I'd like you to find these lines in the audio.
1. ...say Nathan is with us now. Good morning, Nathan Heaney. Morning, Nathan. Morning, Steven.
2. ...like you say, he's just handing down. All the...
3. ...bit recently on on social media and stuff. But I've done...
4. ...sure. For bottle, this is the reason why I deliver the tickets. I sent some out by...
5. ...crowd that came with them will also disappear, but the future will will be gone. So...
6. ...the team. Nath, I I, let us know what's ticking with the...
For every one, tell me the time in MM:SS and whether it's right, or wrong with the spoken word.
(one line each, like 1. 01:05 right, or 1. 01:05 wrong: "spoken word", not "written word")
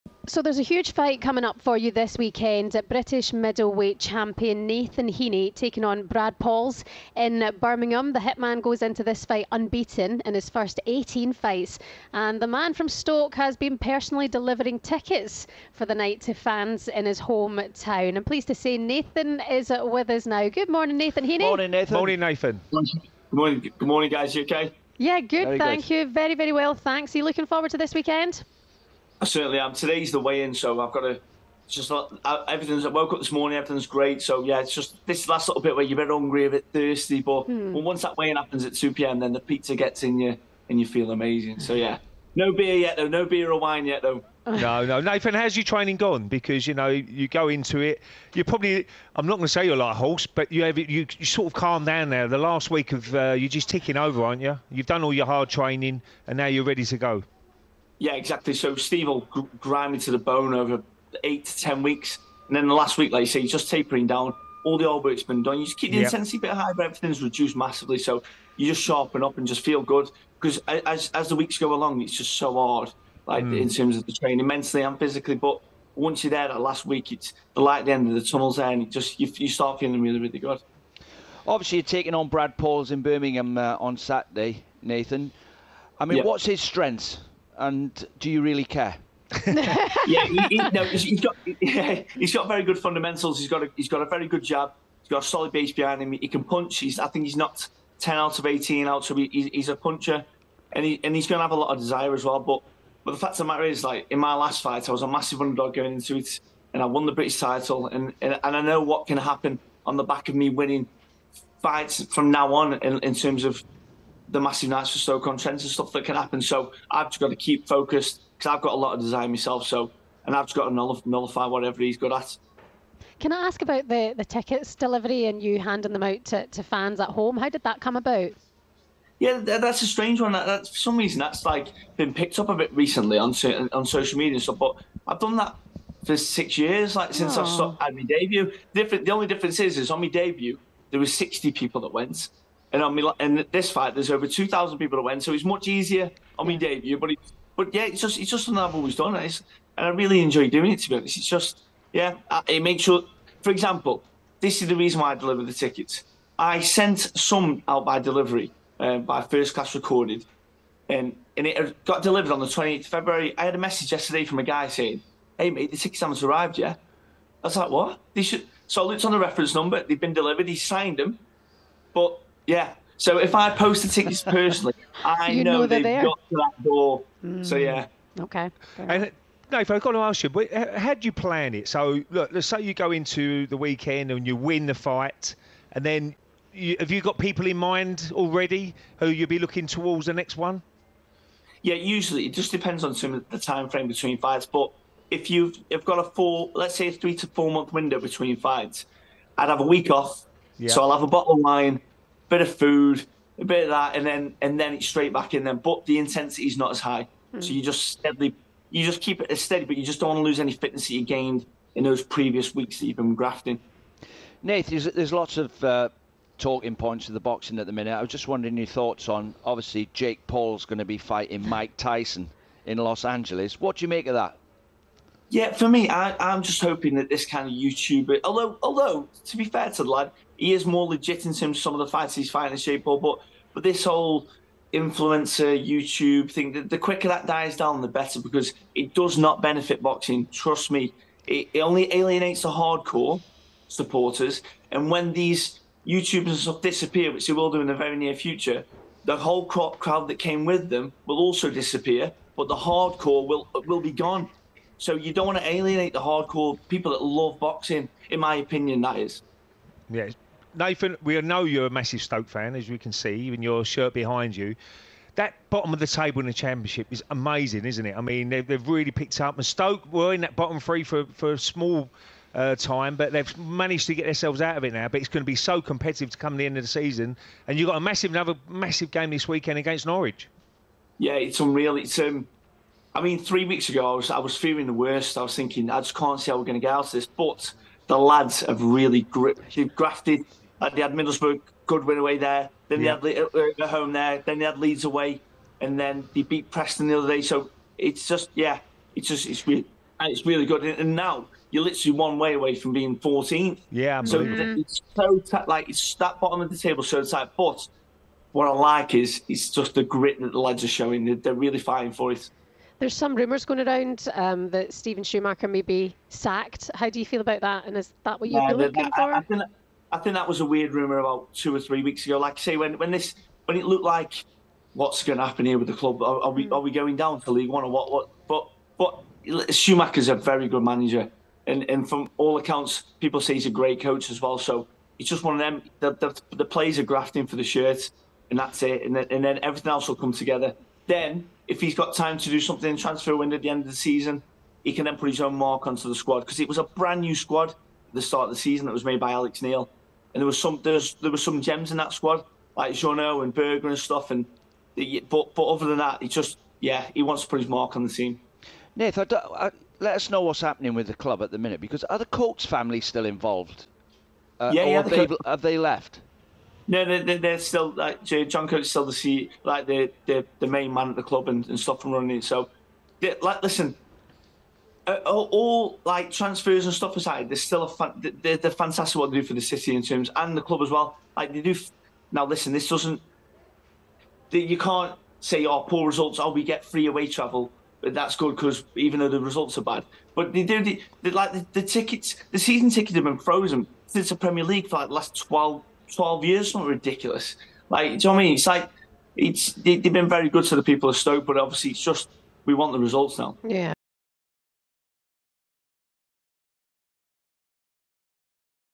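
1. 00:18 wrong: "Nathan", not "Steven"
2. 01:03 wrong: "tapering", not "handing"
3. 02:12 right
4. 02:32 wrong: "example", not "bottle"
5. 04:09 wrong: "hardcore", not "future"
6. 05:57 wrong: "happening", not "ticking".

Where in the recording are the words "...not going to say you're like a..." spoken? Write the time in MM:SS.
00:49.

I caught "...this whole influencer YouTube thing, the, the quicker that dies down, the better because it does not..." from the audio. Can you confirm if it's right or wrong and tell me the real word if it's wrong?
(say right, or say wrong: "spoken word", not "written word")
right.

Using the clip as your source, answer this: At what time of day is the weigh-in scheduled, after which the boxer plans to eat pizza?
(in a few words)
2 p.m.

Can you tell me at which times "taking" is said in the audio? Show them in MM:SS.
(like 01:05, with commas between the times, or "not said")
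00:05, 01:21.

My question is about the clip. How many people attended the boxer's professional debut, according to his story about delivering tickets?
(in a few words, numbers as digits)
60.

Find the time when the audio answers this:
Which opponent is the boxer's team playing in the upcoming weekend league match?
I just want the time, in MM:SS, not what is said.
04:39.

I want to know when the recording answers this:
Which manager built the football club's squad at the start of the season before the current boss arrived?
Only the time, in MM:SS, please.
05:49.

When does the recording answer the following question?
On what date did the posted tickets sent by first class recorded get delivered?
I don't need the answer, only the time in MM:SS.
02:42.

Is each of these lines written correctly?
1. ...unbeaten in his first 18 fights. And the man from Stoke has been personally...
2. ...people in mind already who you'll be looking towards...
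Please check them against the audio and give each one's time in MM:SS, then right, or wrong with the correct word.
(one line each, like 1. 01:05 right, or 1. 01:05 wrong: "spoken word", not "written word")
1. 00:09 right
2. 03:07 right.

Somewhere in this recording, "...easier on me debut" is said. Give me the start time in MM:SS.
02:25.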